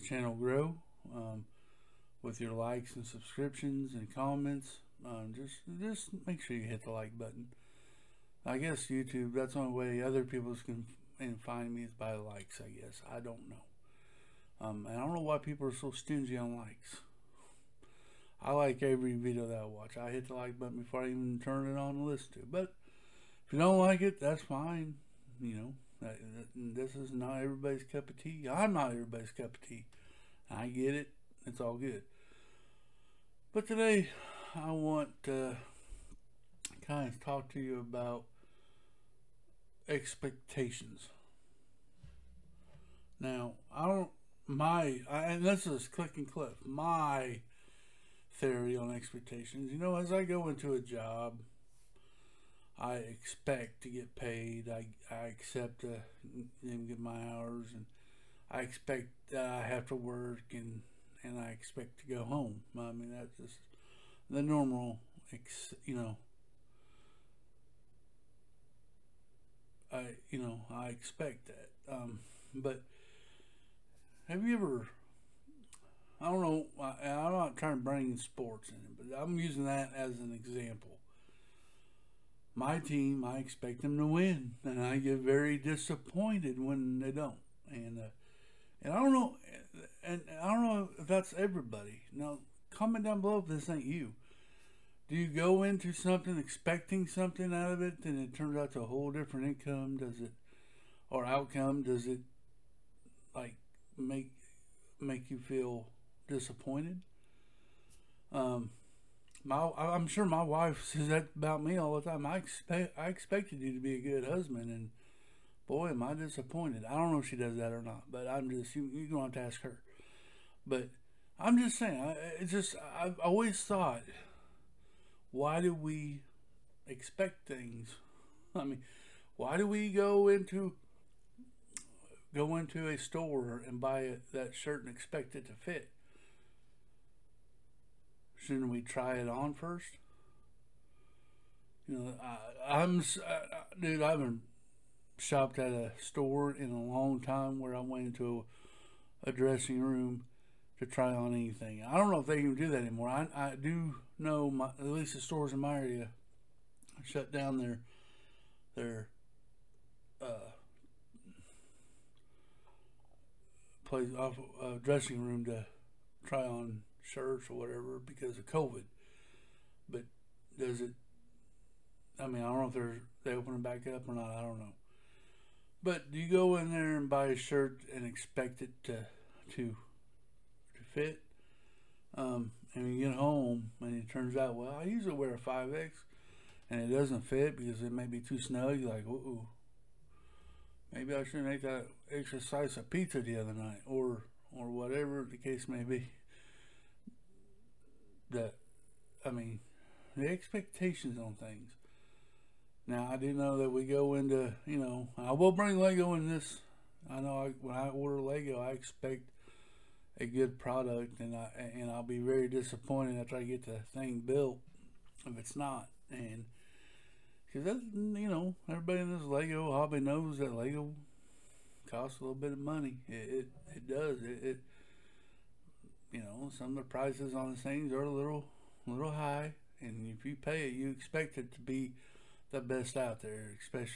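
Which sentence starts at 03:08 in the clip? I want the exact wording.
You're like, ooh, maybe I shouldn't make that extra slice of pizza the other night or, or whatever the case may be.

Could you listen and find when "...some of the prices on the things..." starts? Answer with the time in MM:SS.
03:46.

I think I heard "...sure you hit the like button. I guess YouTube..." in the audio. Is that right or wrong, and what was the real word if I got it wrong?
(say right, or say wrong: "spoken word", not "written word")
right.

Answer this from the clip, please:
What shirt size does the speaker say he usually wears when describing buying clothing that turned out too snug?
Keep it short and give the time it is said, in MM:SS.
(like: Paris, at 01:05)
5X, at 03:05.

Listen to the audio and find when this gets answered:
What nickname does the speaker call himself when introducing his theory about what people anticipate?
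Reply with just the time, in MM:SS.
00:45.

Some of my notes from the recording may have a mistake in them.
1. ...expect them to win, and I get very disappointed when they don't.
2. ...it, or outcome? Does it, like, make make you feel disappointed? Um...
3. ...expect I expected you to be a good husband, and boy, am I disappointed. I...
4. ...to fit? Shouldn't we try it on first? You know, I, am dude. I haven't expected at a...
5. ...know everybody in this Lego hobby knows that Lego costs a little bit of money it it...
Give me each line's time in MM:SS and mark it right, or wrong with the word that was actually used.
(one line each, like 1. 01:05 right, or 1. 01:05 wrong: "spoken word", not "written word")
1. 01:23 right
2. 01:40 right
3. 01:52 right
4. 02:15 wrong: "shopped", not "expected"
5. 03:38 right.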